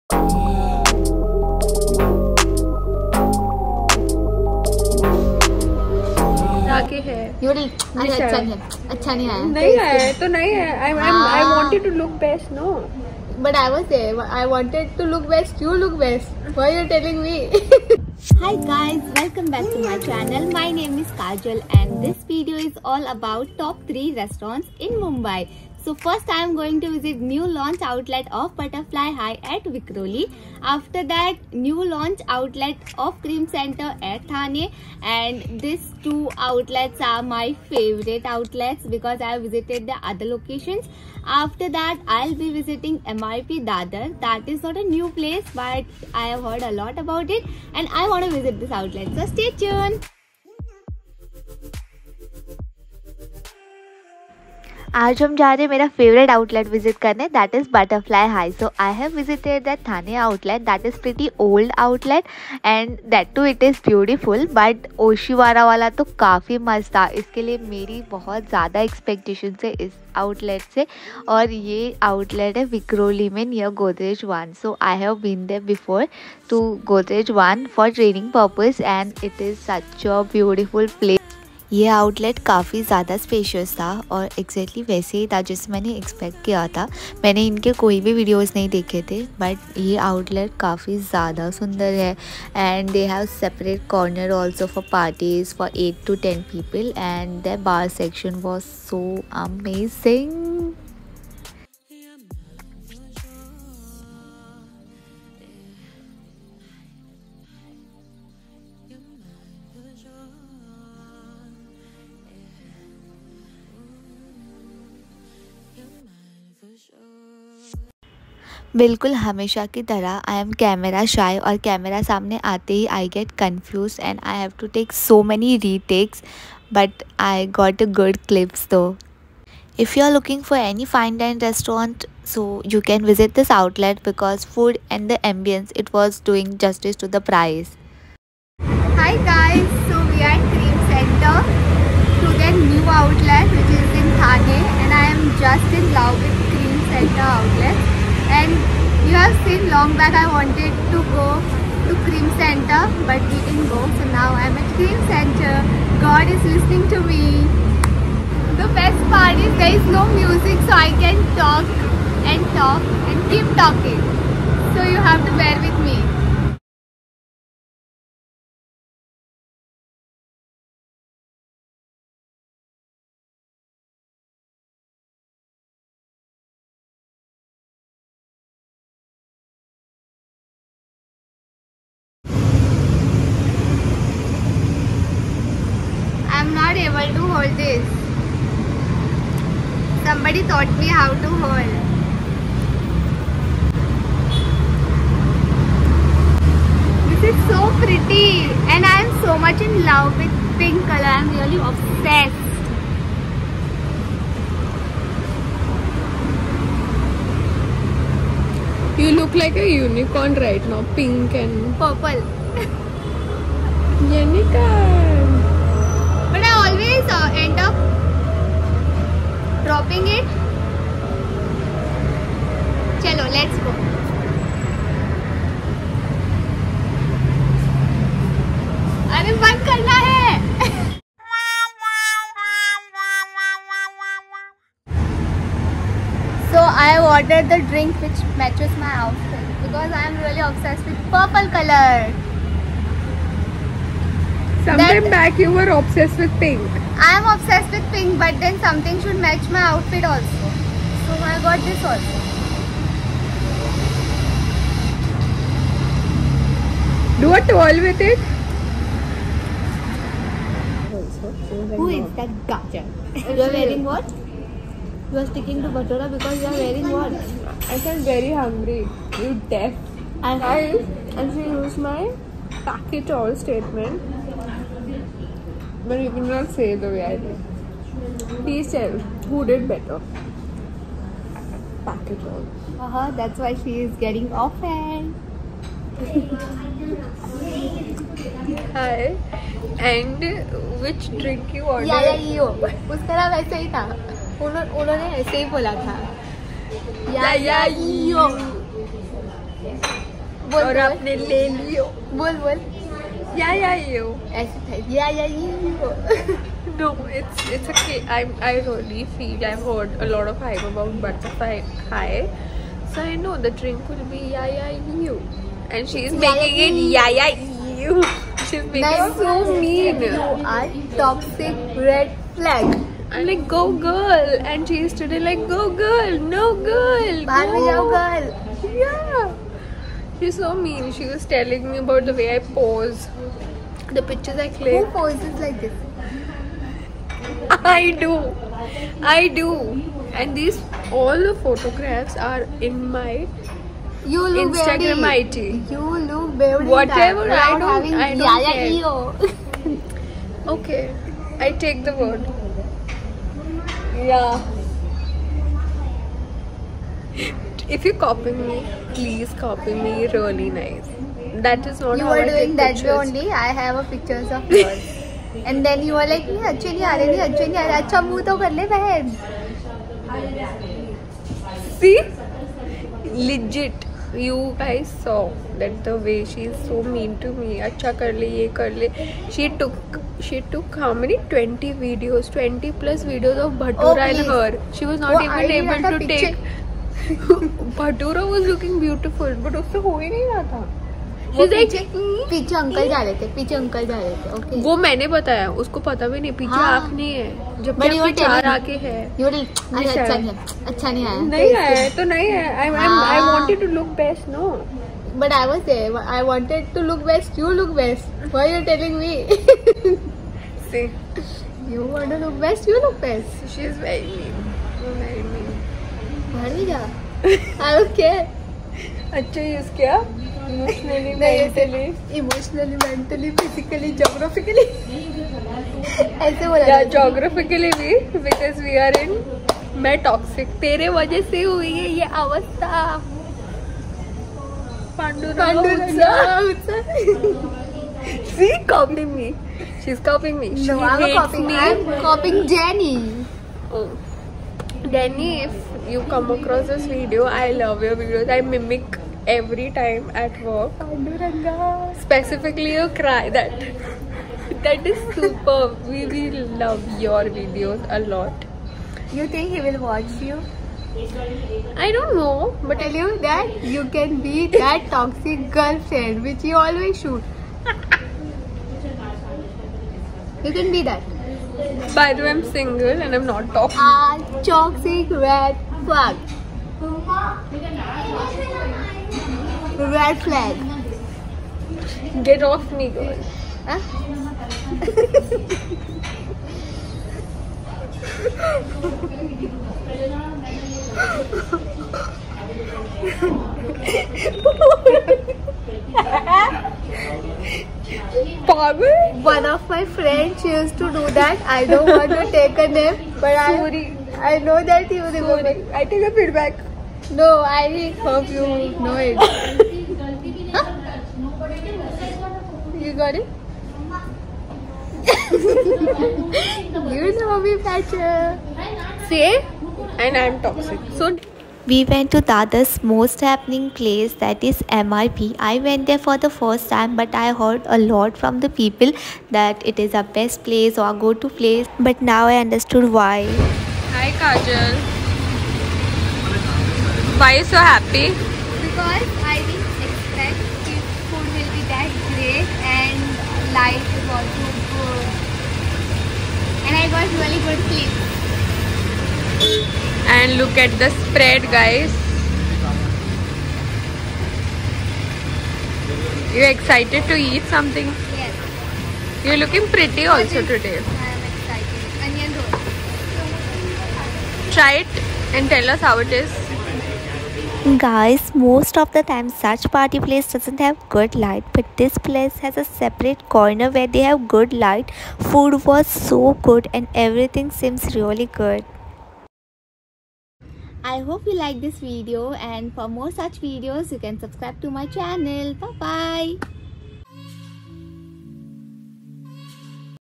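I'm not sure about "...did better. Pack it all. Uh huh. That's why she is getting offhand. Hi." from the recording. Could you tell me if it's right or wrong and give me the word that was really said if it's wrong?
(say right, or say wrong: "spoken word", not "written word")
right.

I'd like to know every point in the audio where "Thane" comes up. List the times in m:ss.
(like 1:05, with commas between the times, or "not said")
0:34, 2:24.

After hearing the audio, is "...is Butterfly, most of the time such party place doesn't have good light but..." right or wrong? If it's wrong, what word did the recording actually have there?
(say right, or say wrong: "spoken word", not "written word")
wrong: "Guys", not "Butterfly".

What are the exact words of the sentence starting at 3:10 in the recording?
Somebody taught me how to hold.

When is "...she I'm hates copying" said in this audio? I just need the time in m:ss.
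7:20.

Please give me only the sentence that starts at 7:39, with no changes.
You think he will watch you?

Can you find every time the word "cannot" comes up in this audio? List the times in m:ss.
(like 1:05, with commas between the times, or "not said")
4:36.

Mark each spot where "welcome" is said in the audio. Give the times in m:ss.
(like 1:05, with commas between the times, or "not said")
0:19.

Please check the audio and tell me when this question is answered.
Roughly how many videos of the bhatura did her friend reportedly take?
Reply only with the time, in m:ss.
6:22.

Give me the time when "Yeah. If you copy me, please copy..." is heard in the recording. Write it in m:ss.
5:54.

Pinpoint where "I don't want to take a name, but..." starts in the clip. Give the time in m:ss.
8:21.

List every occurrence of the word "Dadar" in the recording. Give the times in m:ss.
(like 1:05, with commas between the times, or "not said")
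0:43, 8:42.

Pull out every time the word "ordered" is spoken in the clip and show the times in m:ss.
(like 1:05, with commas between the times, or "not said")
3:57, 4:51.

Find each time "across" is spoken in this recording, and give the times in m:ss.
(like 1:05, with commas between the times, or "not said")
7:26.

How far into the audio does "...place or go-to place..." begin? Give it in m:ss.
8:50.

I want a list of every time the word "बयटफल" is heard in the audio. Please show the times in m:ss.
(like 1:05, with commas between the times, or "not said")
1:03, 1:20, 6:28.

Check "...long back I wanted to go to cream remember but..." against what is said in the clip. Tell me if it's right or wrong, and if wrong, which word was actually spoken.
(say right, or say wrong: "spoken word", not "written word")
wrong: "center", not "remember".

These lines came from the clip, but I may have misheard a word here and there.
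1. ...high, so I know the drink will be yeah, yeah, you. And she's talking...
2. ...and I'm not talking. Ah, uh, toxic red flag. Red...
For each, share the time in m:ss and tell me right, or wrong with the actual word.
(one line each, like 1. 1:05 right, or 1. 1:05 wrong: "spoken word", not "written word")
1. 5:11 wrong: "making", not "talking"
2. 7:53 right.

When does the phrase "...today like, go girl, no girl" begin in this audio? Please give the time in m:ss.
5:24.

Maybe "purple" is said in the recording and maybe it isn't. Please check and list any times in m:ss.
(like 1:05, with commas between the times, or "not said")
3:31, 4:01.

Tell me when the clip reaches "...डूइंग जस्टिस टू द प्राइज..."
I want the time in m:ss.
2:16.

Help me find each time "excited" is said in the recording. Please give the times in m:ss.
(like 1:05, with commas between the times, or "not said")
9:16, 9:21.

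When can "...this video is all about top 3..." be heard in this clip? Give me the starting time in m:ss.
0:22.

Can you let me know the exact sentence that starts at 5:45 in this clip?
You look very Whatever I don't, I don't care.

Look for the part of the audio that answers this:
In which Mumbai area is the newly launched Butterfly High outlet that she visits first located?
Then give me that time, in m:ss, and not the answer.
0:29.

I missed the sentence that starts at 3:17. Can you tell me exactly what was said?
This is so pretty and I am so much in love with pink color.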